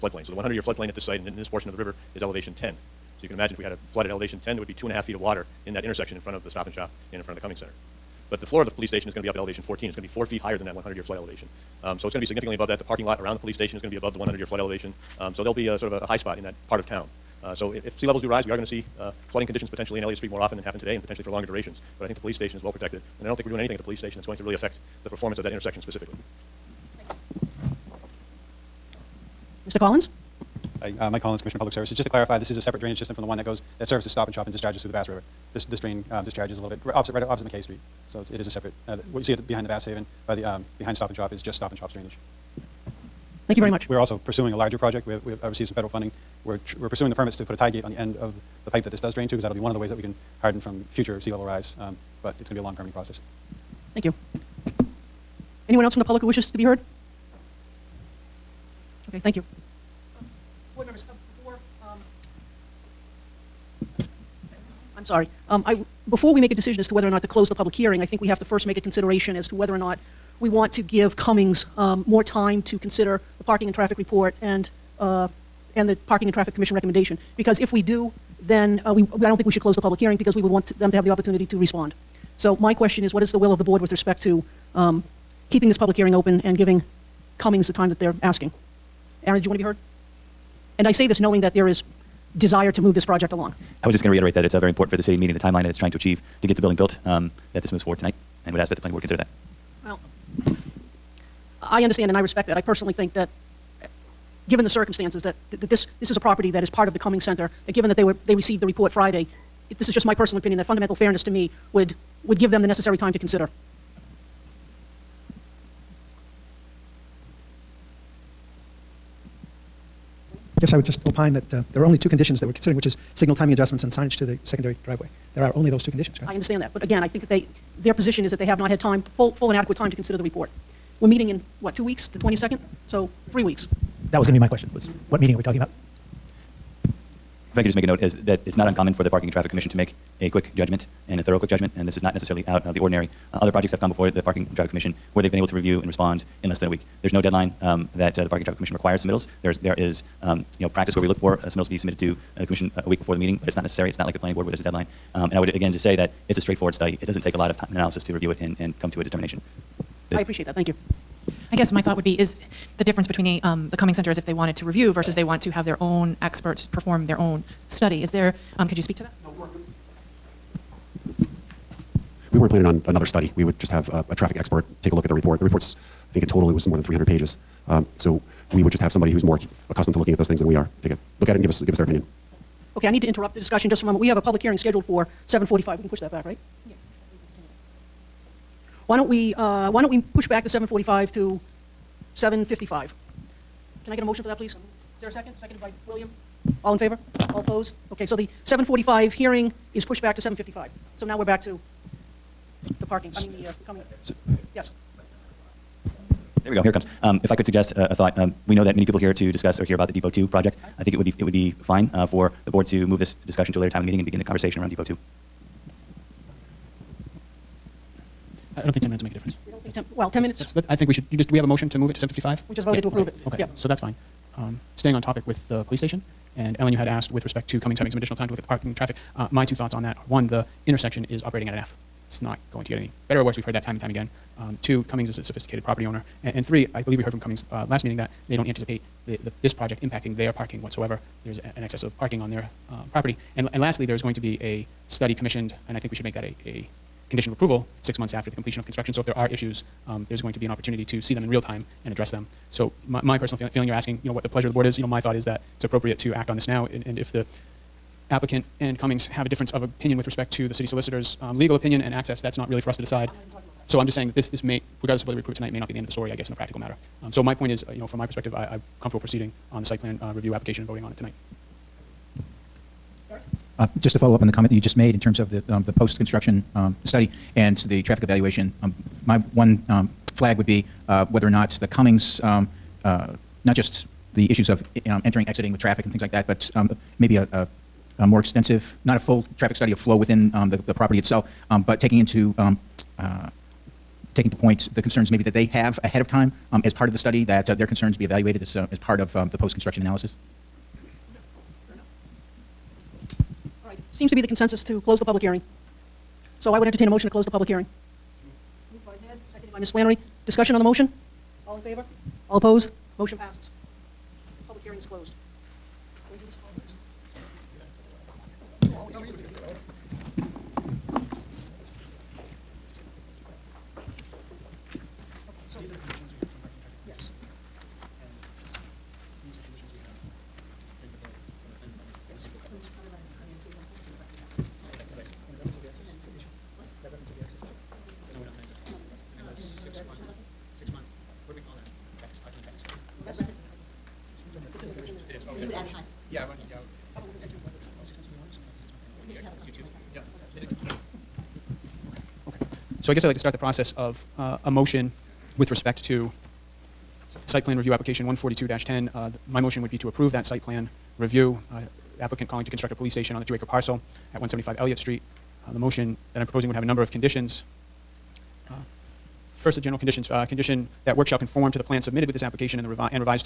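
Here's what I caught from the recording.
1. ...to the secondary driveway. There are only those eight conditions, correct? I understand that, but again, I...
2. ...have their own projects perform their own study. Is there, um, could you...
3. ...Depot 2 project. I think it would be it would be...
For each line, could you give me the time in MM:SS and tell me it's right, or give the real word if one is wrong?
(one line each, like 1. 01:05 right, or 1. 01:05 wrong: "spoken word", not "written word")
1. 02:04 wrong: "two", not "eight"
2. 02:45 wrong: "experts", not "projects"
3. 03:29 right.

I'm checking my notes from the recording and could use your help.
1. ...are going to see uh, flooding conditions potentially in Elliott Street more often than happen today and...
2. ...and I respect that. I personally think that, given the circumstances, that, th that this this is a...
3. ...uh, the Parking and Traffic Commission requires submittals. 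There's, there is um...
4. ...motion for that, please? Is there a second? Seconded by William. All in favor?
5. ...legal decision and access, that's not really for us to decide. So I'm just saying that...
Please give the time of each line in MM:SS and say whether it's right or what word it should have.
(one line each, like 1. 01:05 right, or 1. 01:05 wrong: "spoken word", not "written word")
1. 00:18 right
2. 01:42 right
3. 02:28 right
4. 03:14 right
5. 04:21 wrong: "opinion", not "decision".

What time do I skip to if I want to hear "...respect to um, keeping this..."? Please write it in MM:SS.
01:23.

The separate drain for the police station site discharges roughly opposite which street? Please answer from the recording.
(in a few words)
McKay Street.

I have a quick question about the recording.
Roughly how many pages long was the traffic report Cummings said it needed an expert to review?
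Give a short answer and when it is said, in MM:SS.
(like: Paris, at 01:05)
more than 300, at 02:56.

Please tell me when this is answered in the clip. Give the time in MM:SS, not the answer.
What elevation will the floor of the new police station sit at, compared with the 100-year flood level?
00:09.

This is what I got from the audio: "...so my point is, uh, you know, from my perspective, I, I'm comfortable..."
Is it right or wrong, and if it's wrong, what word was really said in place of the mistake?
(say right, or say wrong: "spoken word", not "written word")
right.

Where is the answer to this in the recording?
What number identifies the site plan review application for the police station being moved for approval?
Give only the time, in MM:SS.
05:58.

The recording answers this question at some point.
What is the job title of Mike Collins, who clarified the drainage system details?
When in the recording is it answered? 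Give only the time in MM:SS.
00:31.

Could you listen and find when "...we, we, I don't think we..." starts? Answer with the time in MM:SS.
01:18.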